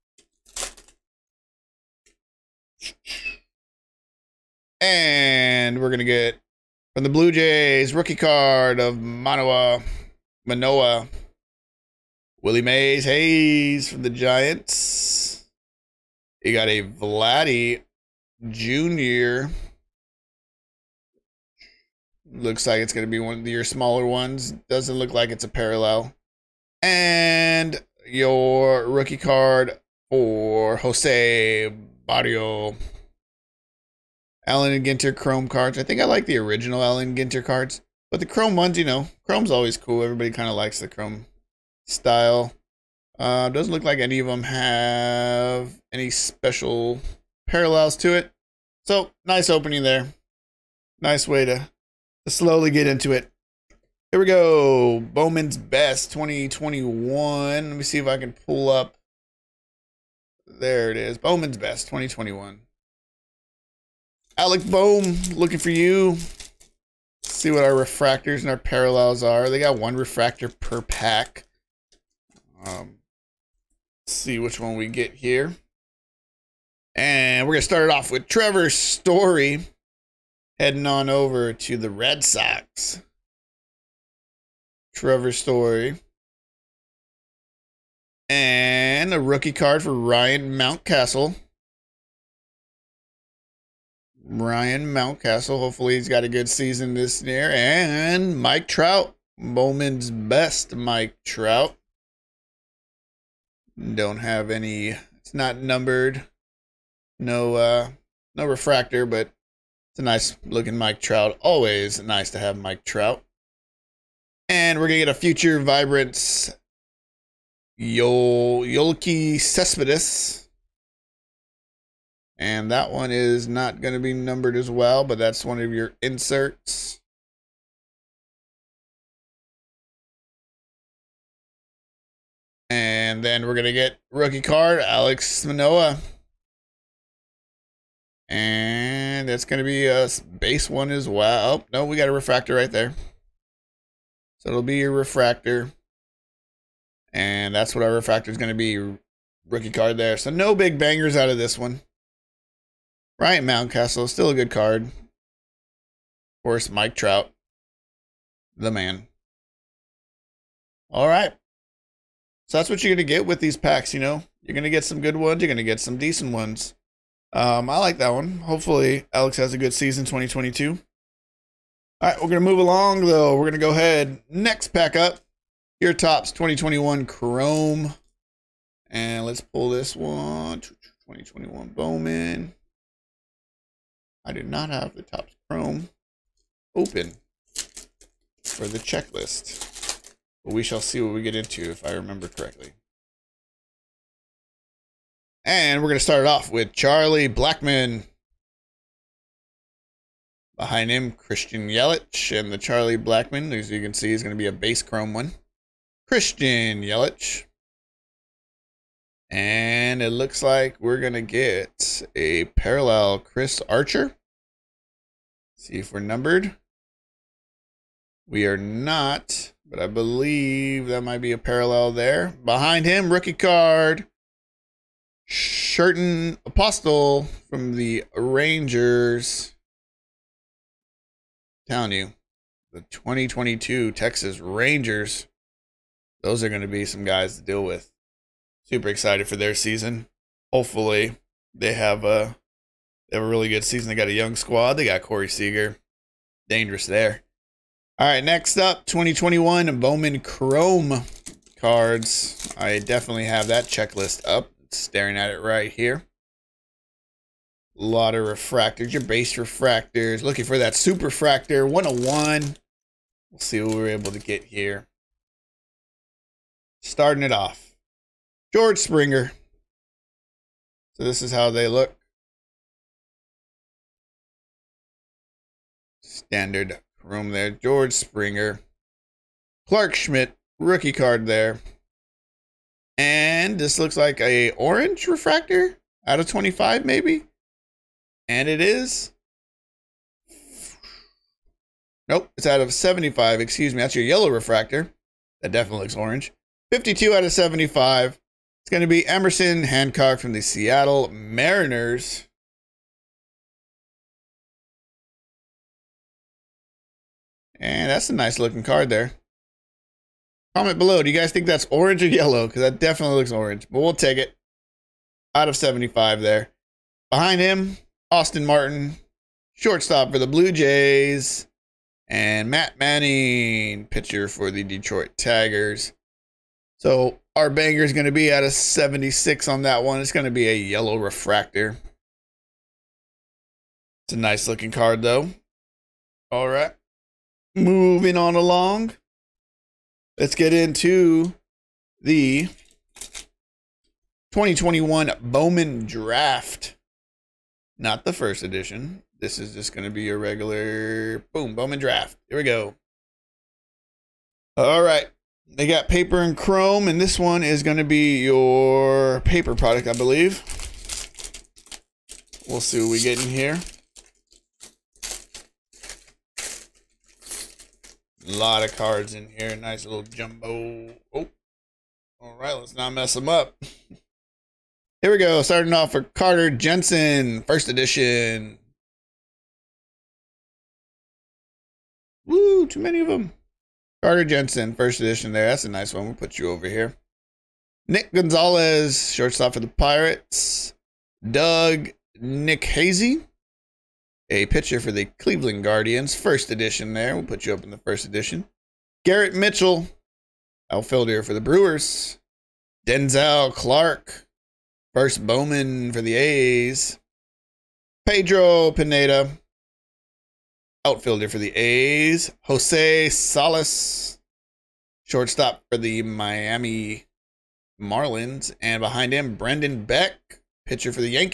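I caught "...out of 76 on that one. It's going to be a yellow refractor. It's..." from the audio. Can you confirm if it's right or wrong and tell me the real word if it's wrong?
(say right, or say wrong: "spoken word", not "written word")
right.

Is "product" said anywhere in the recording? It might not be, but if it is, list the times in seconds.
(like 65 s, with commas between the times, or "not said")
359 s.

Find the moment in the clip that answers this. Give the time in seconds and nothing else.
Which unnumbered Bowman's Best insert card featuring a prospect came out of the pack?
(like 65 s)
115 s.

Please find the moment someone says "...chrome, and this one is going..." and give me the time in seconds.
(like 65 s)
356 s.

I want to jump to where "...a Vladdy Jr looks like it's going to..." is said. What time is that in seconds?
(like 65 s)
16 s.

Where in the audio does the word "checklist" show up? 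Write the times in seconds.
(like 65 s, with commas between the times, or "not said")
188 s, 253 s.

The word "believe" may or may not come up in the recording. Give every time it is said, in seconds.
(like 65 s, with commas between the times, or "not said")
219 s, 359 s.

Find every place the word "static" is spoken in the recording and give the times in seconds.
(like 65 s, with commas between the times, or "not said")
not said.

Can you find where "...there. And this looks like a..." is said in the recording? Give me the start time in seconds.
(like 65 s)
281 s.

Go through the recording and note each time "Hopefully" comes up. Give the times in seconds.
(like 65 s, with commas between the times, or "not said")
95 s, 168 s, 240 s.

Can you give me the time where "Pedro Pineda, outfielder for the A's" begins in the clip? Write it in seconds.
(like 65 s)
408 s.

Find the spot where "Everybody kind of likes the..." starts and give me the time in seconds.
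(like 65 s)
40 s.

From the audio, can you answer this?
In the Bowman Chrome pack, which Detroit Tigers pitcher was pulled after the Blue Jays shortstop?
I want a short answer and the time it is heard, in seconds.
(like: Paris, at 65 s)
Matt Manning, at 322 s.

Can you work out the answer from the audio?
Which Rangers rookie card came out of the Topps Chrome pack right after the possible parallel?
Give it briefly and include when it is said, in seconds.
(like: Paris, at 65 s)
Sherten Apostel, at 225 s.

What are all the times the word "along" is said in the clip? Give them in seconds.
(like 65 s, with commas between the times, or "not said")
172 s, 338 s.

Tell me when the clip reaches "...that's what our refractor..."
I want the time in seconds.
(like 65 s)
147 s.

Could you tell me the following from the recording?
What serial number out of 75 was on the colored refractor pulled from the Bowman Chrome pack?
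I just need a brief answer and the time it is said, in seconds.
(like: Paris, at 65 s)
52, at 296 s.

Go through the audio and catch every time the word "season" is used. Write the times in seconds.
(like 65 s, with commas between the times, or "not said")
96 s, 169 s, 239 s, 243 s.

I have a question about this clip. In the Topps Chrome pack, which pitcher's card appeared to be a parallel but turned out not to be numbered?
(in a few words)
Chris Archer.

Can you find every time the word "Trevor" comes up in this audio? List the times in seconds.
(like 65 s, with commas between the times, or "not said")
78 s, 84 s.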